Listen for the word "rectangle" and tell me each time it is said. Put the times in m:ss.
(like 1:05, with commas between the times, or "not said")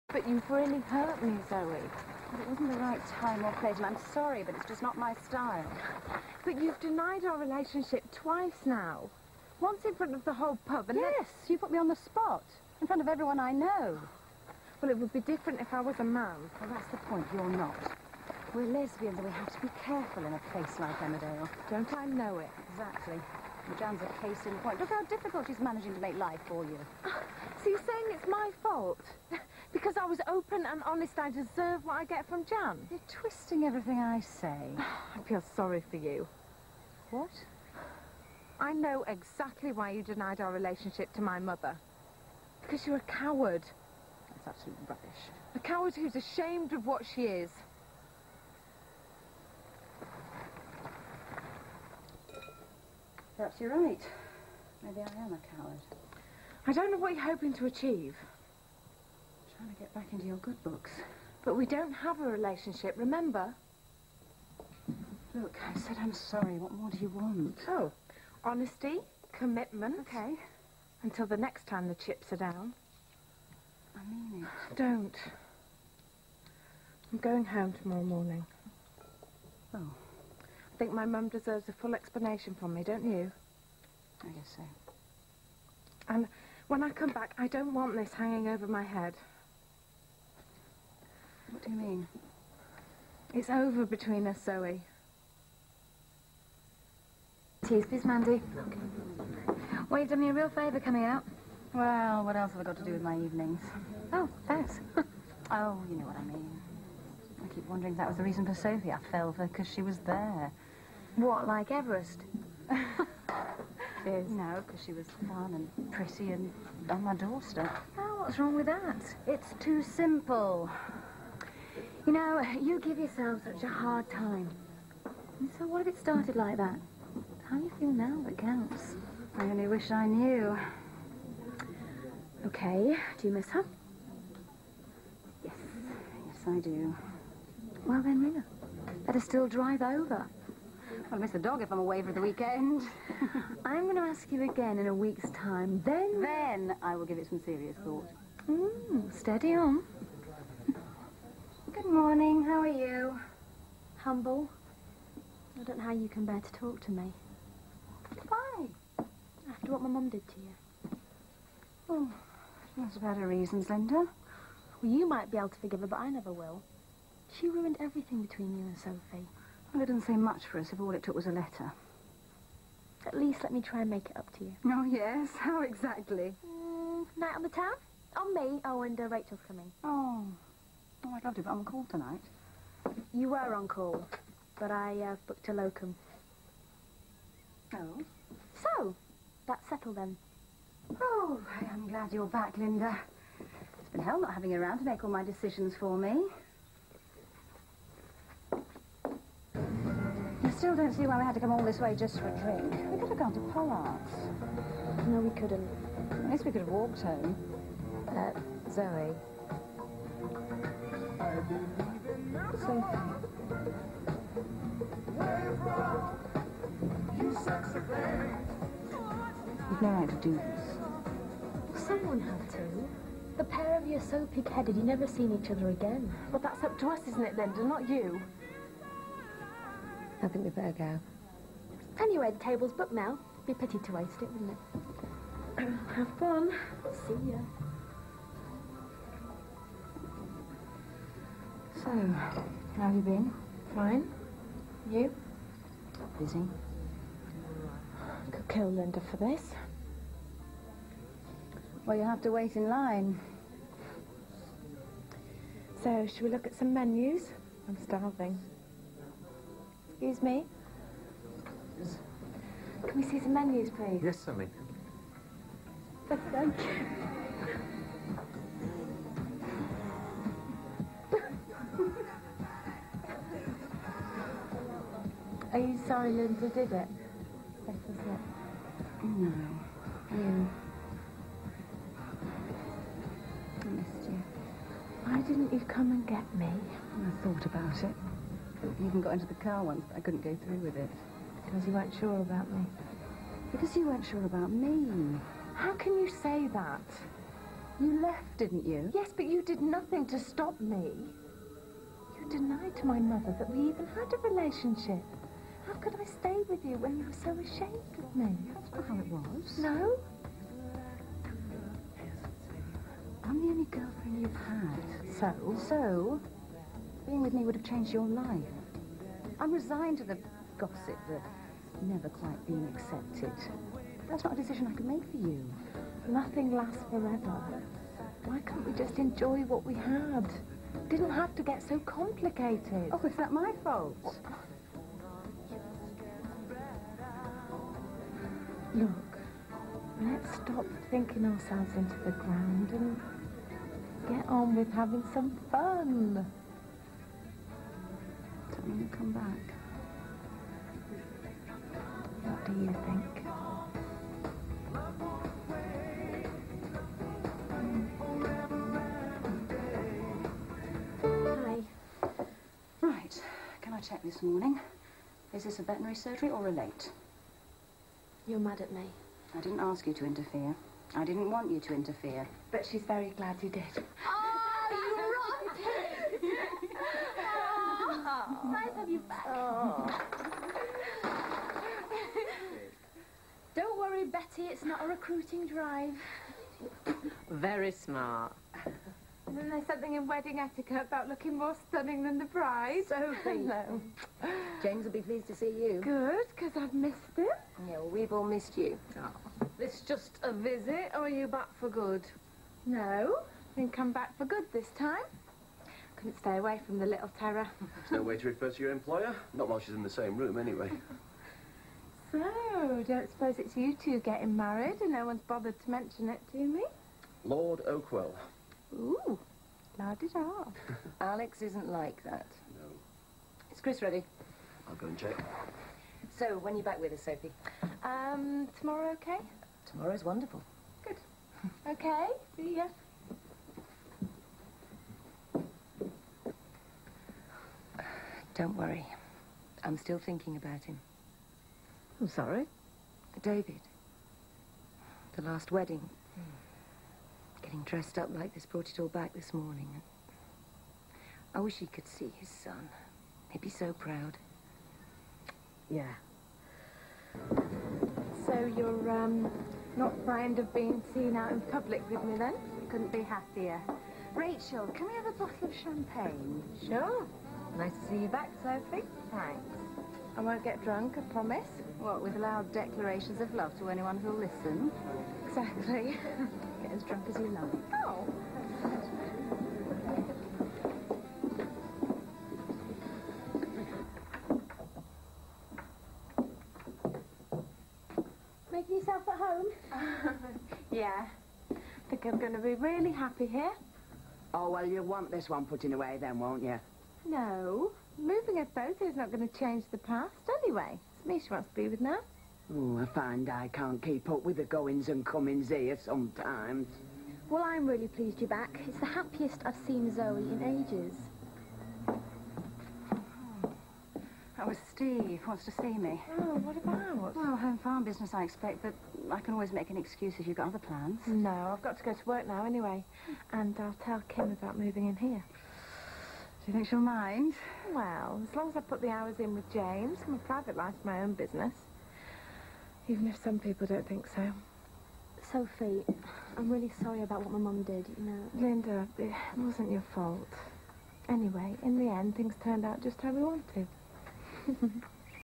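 not said.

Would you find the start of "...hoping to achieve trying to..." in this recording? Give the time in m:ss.
0:57.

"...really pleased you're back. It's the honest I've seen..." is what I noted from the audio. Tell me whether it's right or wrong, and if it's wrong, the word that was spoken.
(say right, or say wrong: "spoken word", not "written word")
wrong: "happiest", not "honest".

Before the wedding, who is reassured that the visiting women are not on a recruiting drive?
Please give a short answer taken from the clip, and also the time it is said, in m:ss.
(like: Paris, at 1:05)
Betty, at 6:24.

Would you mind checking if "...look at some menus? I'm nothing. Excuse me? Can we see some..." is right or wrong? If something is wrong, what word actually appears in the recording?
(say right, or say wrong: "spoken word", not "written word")
wrong: "starving", not "nothing".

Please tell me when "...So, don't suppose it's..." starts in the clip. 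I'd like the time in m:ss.
6:52.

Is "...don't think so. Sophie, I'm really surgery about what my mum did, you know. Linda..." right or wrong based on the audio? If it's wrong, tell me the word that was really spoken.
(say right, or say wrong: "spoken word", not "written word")
wrong: "sorry", not "surgery".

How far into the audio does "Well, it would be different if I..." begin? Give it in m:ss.
0:14.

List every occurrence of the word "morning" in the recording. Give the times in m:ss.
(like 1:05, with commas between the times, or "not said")
1:18, 2:31, 6:04, 7:29.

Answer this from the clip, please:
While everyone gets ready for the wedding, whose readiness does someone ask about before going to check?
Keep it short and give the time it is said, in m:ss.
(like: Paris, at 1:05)
Chris, at 7:03.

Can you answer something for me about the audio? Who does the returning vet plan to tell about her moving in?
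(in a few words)
Kim.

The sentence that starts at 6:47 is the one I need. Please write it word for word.
There's no way to refer to your employer.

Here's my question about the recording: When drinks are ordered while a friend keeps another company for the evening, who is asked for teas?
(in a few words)
Mandy.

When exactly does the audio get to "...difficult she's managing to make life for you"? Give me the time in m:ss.
0:25.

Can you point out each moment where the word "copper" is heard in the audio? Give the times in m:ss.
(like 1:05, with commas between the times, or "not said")
not said.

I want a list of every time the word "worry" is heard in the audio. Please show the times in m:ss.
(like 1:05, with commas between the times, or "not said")
6:23, 7:18.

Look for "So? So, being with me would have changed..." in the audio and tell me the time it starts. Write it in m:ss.
5:15.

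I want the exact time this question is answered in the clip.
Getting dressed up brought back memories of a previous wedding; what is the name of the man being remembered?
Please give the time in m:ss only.
7:23.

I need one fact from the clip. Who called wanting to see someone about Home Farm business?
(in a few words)
Steve.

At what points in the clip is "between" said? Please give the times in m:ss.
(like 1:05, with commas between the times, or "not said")
1:33, 2:48.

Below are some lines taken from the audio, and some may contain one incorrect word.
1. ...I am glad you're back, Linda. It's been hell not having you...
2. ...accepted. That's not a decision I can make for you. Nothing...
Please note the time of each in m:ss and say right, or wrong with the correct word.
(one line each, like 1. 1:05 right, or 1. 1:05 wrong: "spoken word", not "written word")
1. 3:11 right
2. 5:22 right.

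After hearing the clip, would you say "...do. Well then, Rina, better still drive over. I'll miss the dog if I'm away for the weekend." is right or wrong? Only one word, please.
right.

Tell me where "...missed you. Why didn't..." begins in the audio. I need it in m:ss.
4:43.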